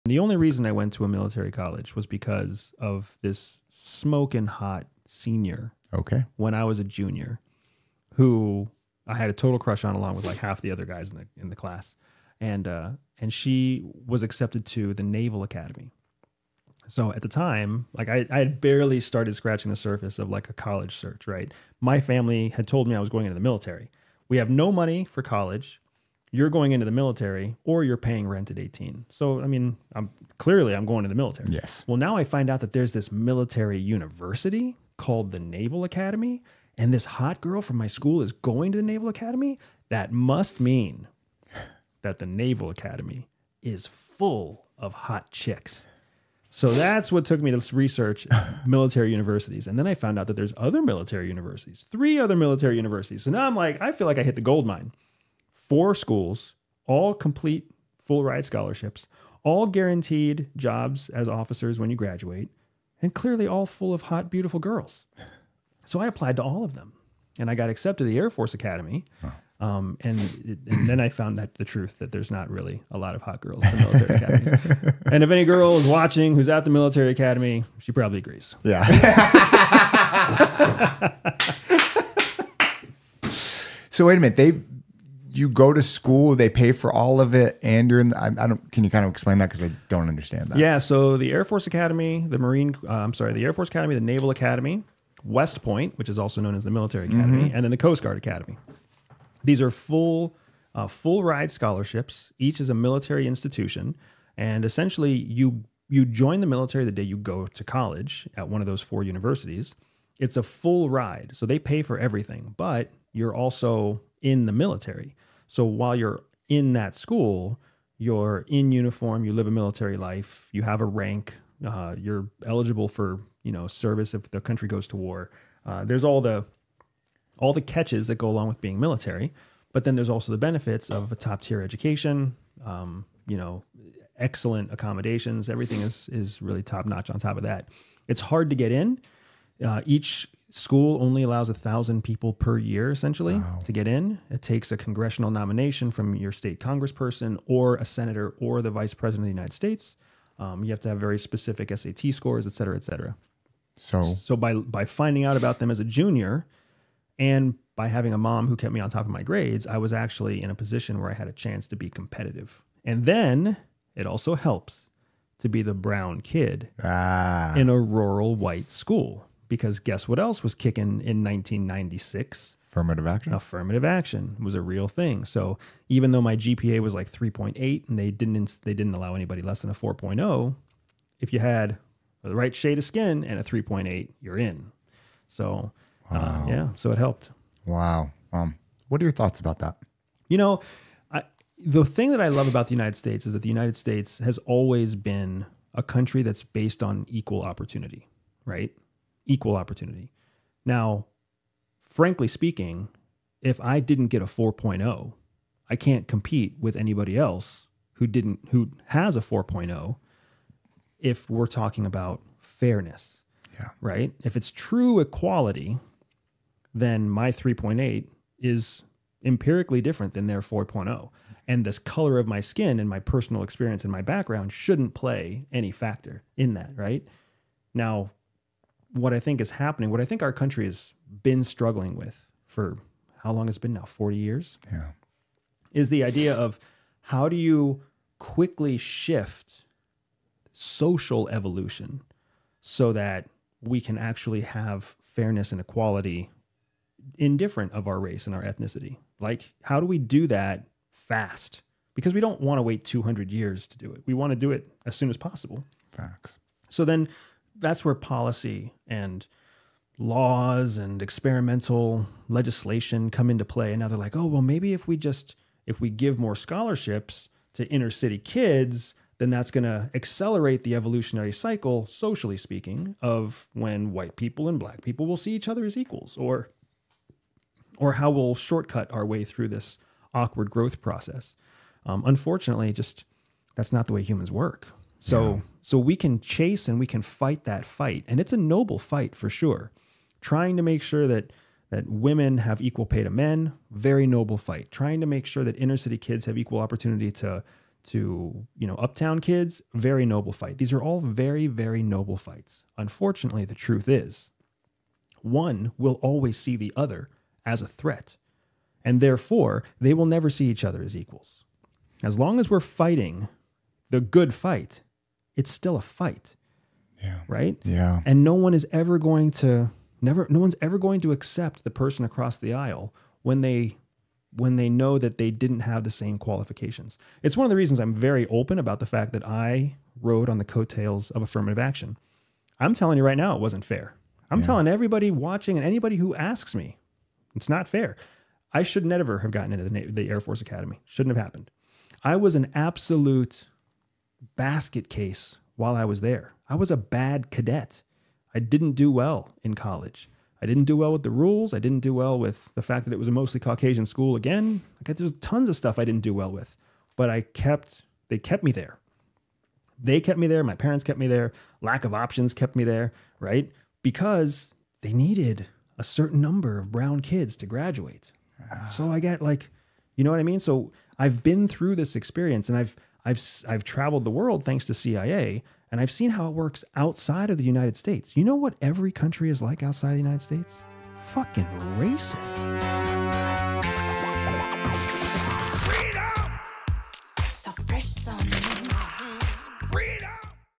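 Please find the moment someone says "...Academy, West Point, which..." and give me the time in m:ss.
1:34.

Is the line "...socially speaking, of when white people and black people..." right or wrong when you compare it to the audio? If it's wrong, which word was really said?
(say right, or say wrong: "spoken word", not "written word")
right.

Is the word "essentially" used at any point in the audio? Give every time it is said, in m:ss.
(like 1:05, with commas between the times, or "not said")
1:44, 2:22.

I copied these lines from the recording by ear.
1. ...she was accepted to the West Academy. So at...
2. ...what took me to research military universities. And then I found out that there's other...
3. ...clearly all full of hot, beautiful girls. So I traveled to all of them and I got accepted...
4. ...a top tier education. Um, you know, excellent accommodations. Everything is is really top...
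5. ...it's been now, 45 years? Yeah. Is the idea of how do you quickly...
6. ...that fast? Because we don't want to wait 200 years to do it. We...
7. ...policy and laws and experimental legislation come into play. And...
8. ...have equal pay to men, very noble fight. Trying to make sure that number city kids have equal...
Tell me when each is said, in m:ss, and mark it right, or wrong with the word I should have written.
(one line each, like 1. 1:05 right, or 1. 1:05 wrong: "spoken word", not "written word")
1. 0:13 wrong: "Naval", not "West"
2. 0:47 right
3. 1:03 wrong: "applied", not "traveled"
4. 2:11 right
5. 3:53 wrong: "40", not "45"
6. 4:10 right
7. 4:17 right
8. 4:52 wrong: "inner", not "number".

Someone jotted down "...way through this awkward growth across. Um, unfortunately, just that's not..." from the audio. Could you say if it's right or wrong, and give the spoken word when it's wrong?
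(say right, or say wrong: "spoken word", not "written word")
wrong: "process", not "across".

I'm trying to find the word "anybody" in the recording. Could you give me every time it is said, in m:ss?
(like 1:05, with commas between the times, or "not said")
2:59, 3:26, 5:35.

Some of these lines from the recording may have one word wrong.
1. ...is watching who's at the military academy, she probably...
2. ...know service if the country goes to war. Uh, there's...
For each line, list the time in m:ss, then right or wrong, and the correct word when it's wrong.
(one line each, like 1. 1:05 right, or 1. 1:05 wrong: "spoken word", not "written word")
1. 1:15 right
2. 2:03 right.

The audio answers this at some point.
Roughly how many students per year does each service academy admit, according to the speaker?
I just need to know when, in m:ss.
2:21.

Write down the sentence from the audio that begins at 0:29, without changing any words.
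So, I mean, I'm clearly I'm going to the military.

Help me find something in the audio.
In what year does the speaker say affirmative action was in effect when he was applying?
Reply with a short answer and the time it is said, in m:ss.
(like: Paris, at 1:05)
1996, at 2:51.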